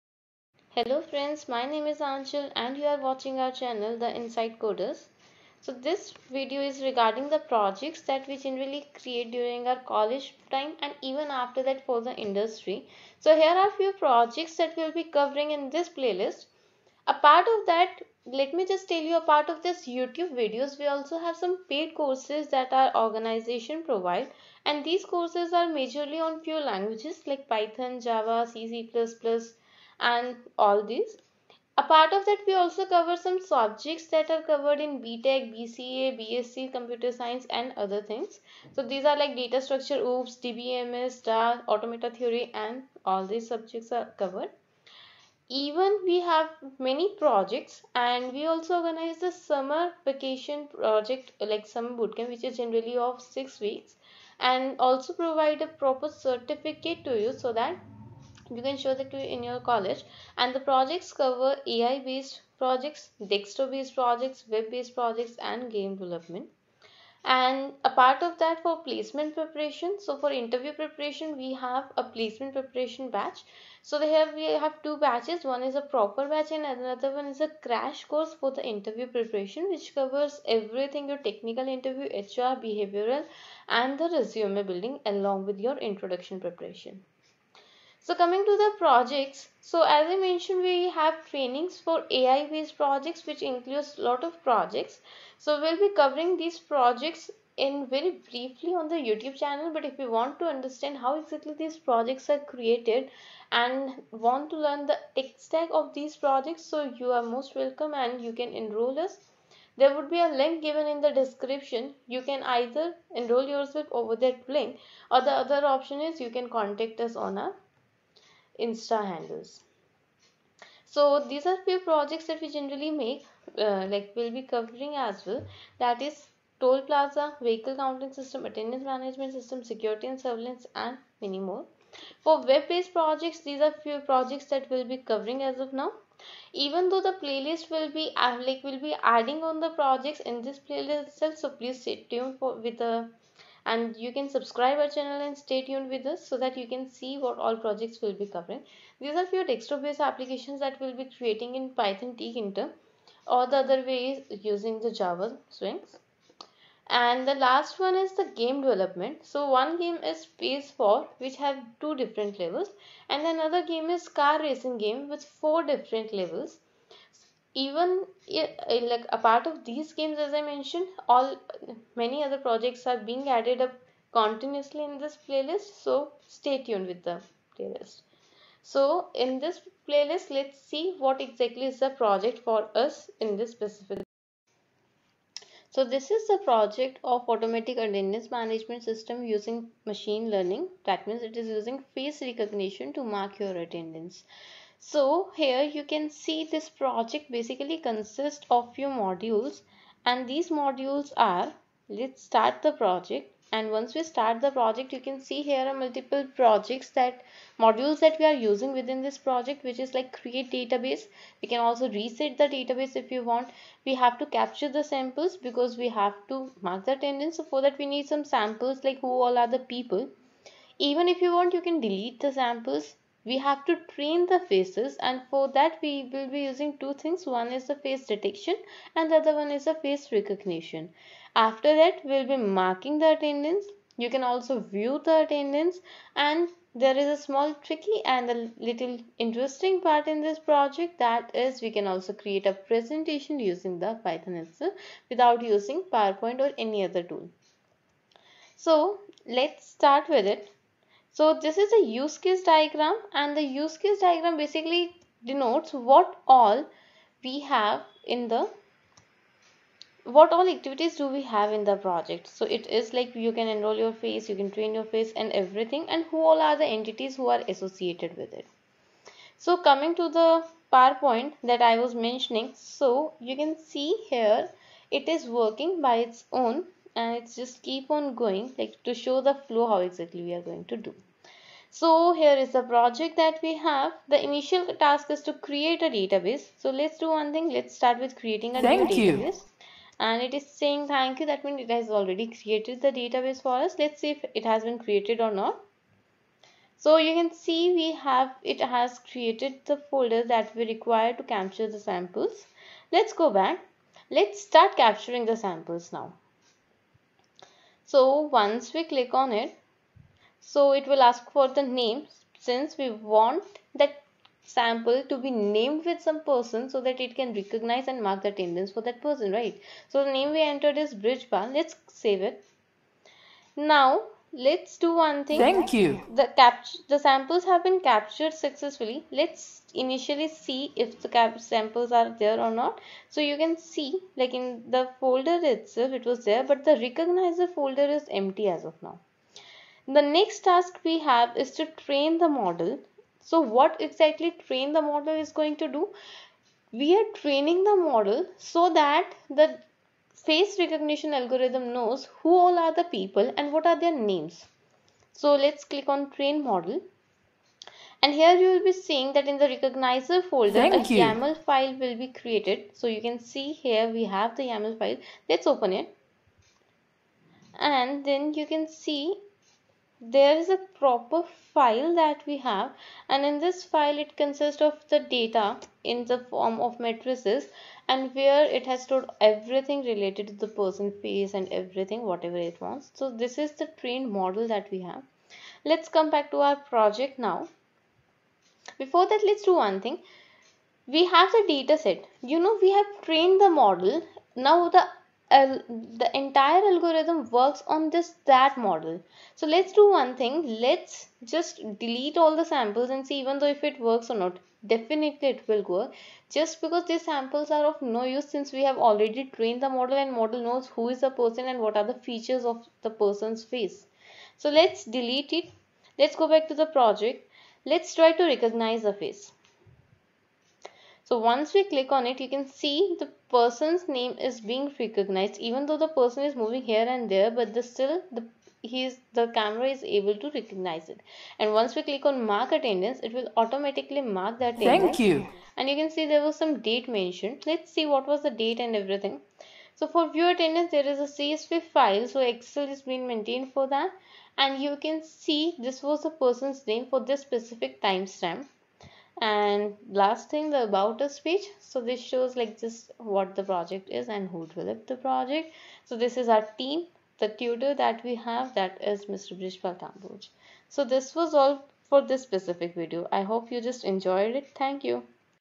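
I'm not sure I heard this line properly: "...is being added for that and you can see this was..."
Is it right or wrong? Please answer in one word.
wrong.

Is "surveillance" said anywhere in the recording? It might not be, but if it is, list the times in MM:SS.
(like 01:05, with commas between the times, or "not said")
02:10.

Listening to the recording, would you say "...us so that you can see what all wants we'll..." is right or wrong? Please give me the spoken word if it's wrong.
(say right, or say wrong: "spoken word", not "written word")
wrong: "projects", not "wants".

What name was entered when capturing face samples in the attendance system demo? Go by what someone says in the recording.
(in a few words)
Bridge.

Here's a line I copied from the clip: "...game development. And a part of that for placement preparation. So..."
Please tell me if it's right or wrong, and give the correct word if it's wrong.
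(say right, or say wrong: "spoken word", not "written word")
right.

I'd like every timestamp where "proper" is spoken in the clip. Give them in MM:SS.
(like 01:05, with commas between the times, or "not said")
00:55, 01:15, 06:10.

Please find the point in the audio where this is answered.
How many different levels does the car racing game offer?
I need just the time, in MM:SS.
02:45.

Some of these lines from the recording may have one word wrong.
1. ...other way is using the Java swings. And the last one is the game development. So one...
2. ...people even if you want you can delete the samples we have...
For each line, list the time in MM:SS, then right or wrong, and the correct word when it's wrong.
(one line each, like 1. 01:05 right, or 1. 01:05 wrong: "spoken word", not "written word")
1. 02:33 right
2. 03:39 right.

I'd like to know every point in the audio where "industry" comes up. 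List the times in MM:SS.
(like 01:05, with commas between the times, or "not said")
00:12.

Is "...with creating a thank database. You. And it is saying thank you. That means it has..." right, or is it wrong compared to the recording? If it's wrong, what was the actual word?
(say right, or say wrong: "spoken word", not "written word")
right.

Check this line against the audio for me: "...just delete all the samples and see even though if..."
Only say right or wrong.
right.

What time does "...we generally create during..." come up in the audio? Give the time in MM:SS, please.
00:08.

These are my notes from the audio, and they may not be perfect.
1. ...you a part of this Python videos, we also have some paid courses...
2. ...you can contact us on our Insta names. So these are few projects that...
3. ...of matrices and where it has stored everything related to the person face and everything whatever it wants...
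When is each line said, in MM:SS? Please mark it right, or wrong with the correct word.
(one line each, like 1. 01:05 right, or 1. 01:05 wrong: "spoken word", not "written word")
1. 00:19 wrong: "YouTube", not "Python"
2. 01:56 wrong: "handles", not "names"
3. 06:16 right.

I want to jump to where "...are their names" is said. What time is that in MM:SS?
05:53.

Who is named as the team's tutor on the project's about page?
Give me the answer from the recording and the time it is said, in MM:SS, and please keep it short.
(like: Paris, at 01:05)
Brishpal Kamboj, at 07:39.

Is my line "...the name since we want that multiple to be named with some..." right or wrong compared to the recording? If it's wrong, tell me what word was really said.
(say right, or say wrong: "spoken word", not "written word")
wrong: "sample", not "multiple".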